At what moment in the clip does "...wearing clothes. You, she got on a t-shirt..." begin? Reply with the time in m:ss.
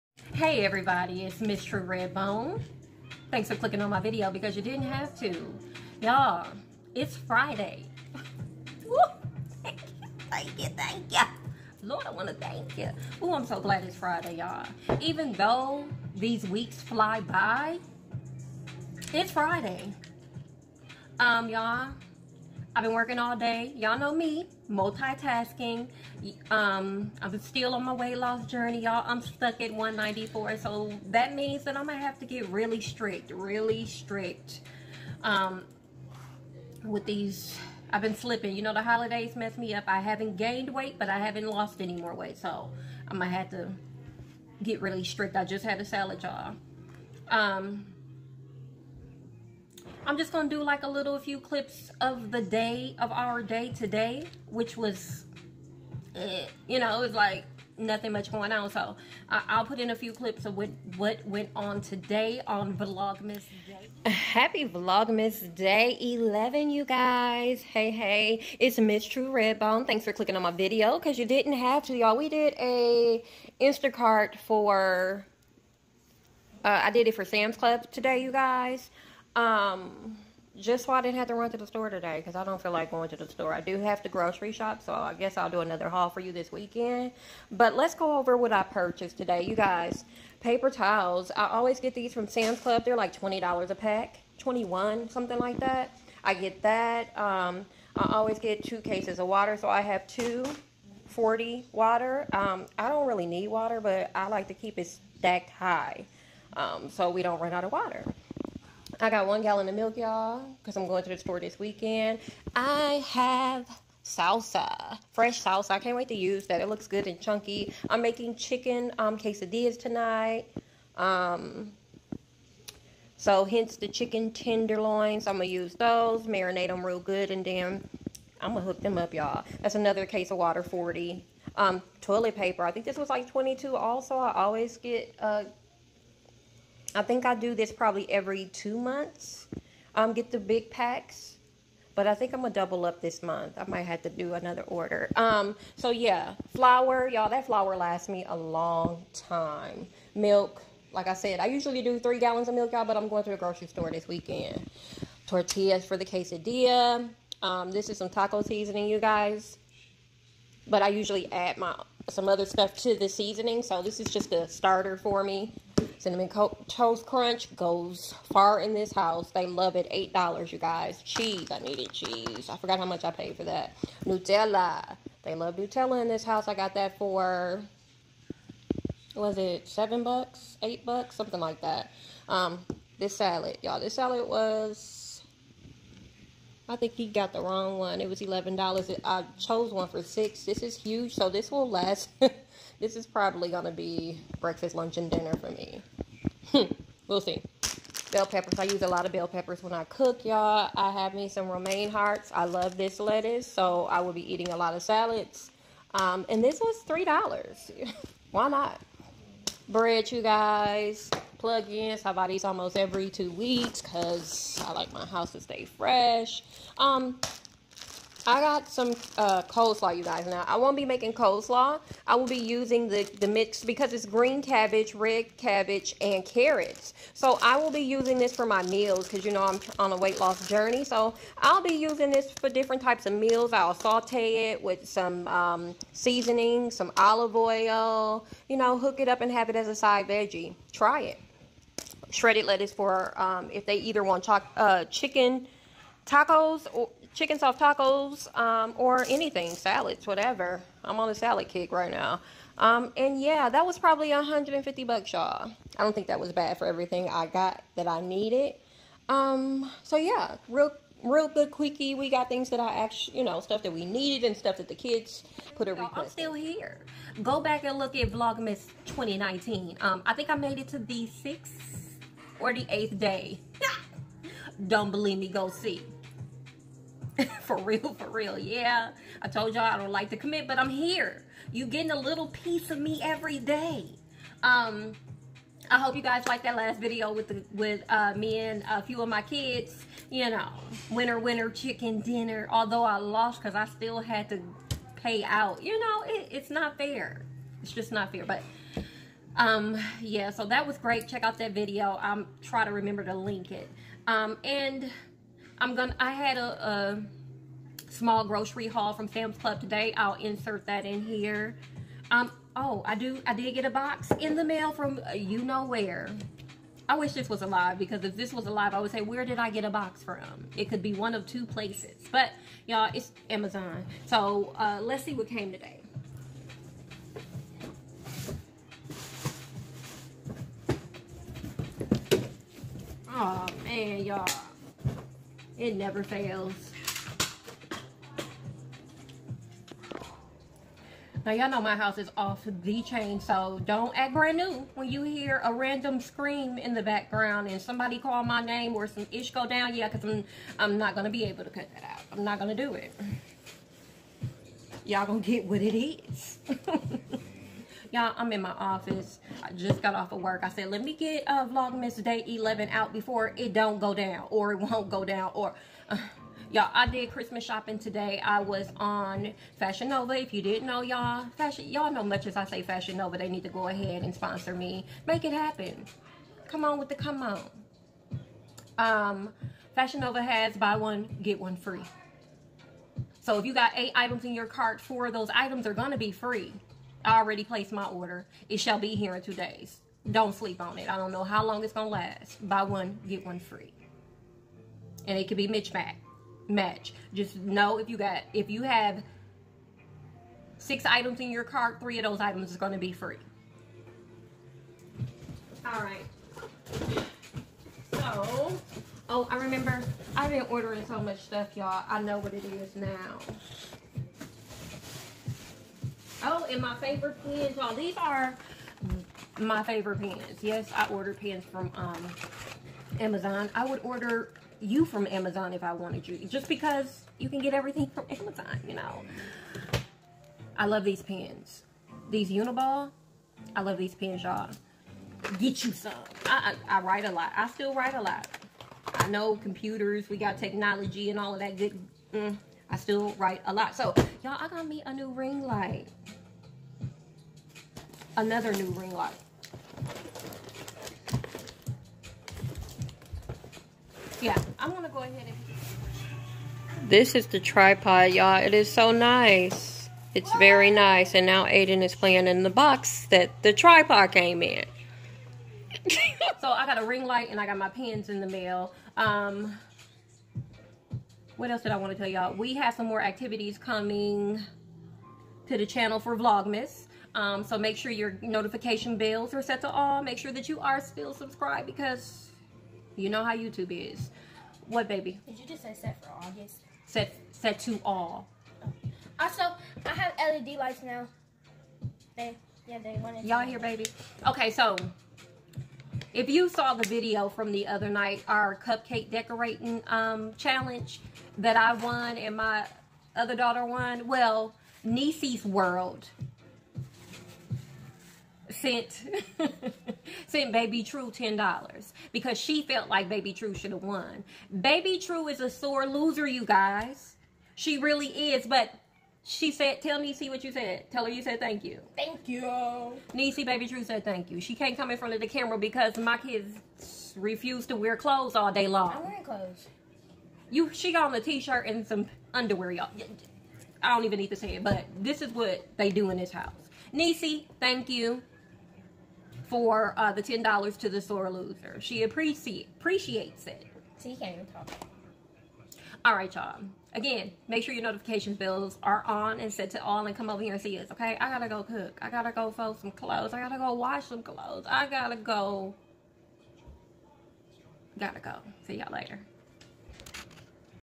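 8:49.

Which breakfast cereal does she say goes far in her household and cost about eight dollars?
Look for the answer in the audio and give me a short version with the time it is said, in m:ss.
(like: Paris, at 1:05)
Cinnamon Toast Crunch, at 2:45.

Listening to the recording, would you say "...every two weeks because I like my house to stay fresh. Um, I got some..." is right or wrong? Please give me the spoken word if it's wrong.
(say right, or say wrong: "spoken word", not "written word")
right.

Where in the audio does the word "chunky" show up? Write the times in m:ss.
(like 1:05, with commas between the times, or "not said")
1:57.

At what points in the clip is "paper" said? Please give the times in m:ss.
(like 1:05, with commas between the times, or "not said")
1:30, 2:12.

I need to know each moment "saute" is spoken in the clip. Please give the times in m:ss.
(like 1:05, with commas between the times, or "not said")
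3:53.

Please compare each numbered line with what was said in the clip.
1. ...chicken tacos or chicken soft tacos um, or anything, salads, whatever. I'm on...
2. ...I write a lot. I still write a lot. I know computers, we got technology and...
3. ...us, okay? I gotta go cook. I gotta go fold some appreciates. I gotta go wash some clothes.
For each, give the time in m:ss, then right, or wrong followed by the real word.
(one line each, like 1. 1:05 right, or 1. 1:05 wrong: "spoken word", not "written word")
1. 4:04 right
2. 7:16 right
3. 9:10 wrong: "clothes", not "appreciates".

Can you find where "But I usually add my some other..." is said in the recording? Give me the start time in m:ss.
2:40.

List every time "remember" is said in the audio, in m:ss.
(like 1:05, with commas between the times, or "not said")
5:02, 6:49.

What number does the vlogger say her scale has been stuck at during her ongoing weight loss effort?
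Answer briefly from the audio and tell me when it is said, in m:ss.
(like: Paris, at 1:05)
194, at 0:29.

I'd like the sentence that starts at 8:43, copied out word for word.
Niecy, Baby True said thank you.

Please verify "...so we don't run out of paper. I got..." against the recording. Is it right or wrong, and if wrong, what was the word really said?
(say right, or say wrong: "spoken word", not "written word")
wrong: "water", not "paper".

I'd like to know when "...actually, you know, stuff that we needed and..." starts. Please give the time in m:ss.
4:22.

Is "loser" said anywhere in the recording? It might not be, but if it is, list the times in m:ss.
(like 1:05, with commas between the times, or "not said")
8:35, 9:01.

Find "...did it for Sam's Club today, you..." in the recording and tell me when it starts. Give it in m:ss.
1:16.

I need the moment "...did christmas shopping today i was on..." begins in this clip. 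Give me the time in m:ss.
6:06.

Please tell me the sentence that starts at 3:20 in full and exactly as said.
I have me some romaine hearts.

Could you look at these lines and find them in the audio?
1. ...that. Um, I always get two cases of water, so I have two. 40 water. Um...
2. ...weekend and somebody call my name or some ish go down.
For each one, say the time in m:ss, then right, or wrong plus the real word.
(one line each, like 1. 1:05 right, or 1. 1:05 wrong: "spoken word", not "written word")
1. 1:36 right
2. 5:46 wrong: "background", not "weekend".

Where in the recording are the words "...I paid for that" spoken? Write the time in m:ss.
2:53.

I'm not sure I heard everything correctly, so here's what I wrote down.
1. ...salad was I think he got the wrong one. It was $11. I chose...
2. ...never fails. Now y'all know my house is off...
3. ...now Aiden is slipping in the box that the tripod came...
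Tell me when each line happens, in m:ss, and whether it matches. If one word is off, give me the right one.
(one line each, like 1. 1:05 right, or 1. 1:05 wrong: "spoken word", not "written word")
1. 3:03 right
2. 5:35 right
3. 7:41 wrong: "playing", not "slipping".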